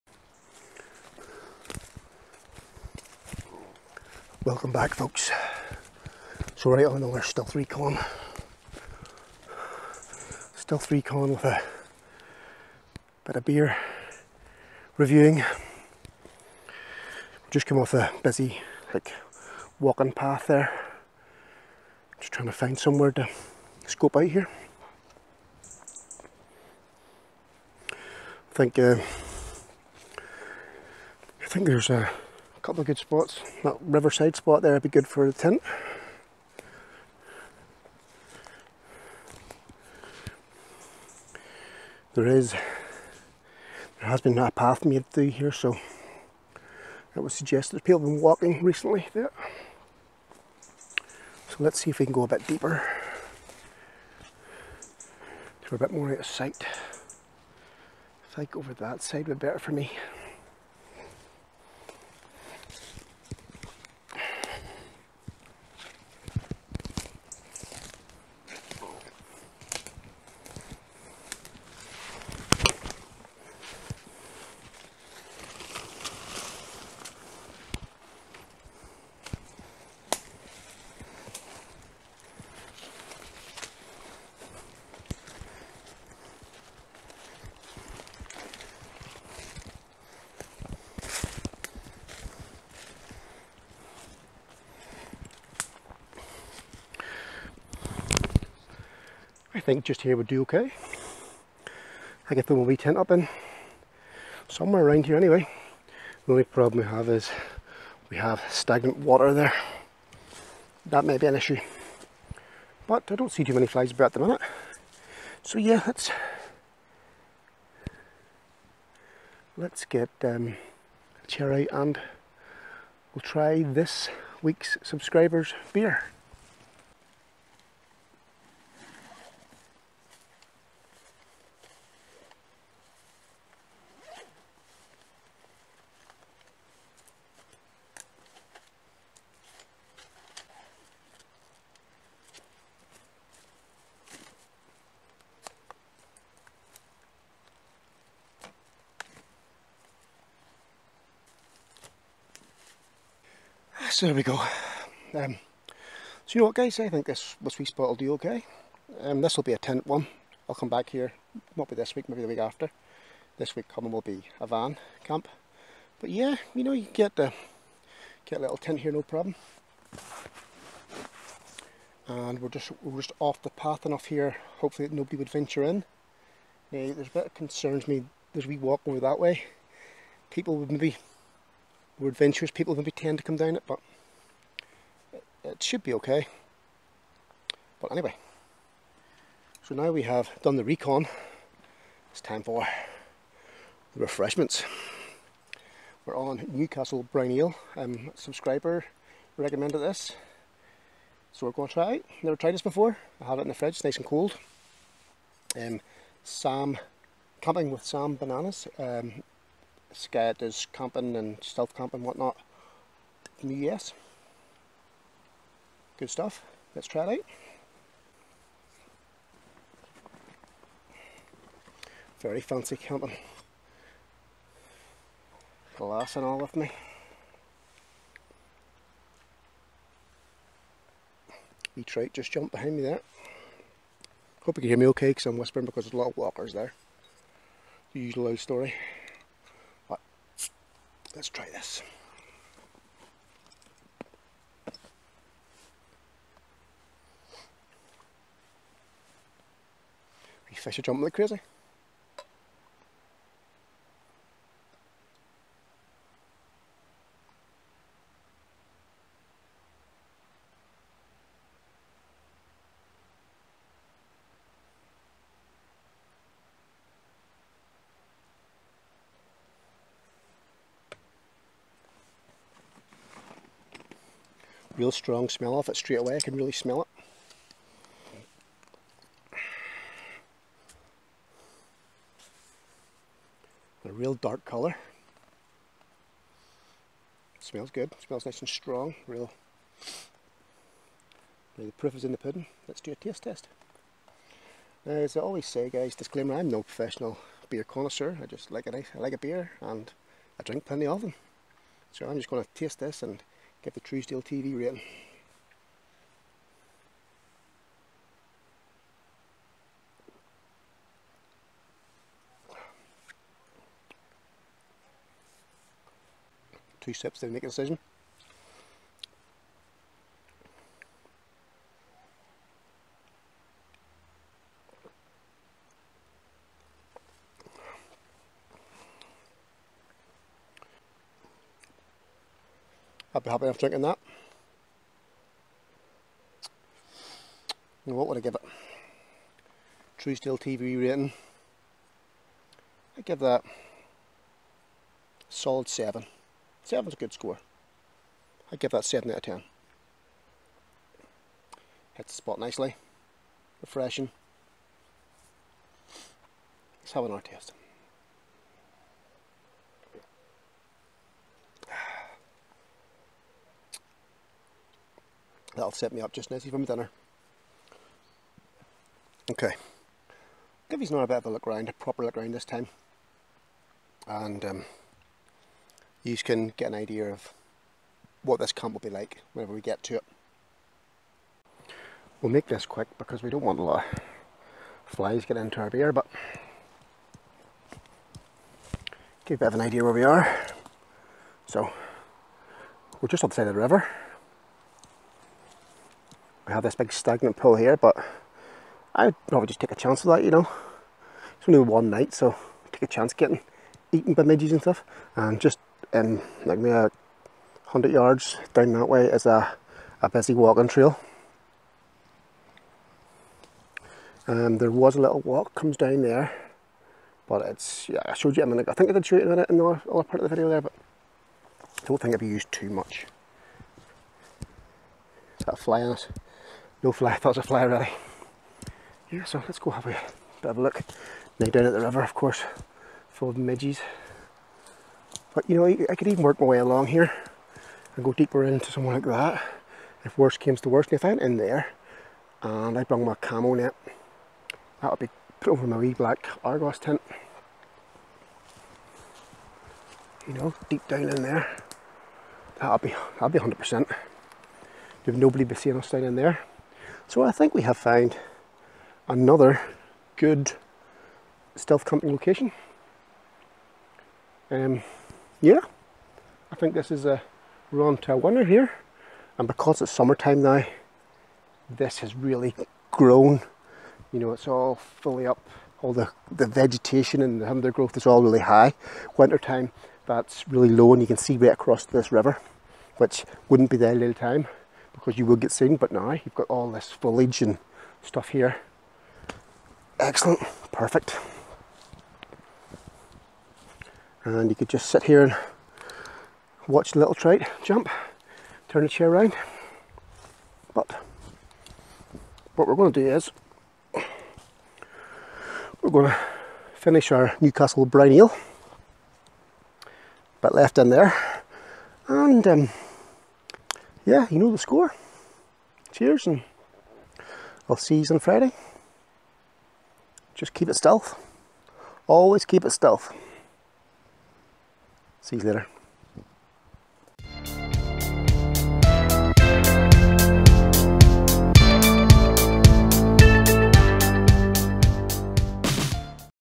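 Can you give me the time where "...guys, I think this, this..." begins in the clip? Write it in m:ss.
2:36.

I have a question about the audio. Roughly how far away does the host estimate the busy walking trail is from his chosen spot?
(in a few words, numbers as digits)
100 yards.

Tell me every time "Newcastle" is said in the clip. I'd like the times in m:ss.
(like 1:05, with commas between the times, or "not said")
3:16, 8:27.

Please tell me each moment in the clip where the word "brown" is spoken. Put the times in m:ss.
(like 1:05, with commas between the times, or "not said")
3:17, 8:27.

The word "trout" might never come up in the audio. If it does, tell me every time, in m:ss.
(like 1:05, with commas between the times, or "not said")
3:51, 8:17.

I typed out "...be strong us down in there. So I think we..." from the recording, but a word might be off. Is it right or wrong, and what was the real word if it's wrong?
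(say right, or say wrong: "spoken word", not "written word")
wrong: "seeing", not "strong".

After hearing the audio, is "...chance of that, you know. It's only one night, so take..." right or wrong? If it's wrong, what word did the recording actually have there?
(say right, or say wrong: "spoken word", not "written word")
right.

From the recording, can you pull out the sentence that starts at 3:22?
Never tried this before, I have it in the fridge, nice and cold.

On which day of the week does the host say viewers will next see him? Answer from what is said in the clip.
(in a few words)
Friday.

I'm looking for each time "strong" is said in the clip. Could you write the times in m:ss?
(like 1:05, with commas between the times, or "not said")
4:34, 4:48.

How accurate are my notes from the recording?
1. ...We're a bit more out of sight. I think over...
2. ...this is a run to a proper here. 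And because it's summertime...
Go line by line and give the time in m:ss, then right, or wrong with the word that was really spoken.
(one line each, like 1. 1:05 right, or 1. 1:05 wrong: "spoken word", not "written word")
1. 0:55 right
2. 7:46 wrong: "winner", not "proper".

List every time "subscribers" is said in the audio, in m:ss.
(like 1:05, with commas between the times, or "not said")
2:04, 3:18.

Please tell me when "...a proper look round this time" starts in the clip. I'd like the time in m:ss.
6:11.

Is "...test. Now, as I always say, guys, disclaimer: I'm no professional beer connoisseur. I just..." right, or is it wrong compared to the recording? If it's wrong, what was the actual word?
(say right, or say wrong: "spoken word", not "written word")
right.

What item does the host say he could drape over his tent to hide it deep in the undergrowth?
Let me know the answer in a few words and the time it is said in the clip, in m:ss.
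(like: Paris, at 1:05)
camo net, at 7:23.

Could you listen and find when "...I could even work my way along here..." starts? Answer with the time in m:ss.
7:15.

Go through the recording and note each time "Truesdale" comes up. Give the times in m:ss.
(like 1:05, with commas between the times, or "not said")
5:03, 5:39.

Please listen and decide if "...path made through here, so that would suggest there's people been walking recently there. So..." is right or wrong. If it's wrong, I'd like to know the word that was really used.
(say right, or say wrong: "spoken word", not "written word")
right.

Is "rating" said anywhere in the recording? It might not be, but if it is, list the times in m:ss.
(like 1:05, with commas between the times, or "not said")
5:04, 5:40.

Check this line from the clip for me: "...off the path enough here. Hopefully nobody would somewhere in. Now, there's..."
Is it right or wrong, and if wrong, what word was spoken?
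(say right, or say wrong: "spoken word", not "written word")
wrong: "venture", not "somewhere".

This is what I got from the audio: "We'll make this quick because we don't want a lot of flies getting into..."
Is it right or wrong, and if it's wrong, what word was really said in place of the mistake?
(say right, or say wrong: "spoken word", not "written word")
right.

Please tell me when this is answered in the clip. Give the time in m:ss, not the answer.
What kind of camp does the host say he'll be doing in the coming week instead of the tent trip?
2:44.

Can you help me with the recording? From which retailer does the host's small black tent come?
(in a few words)
Argos.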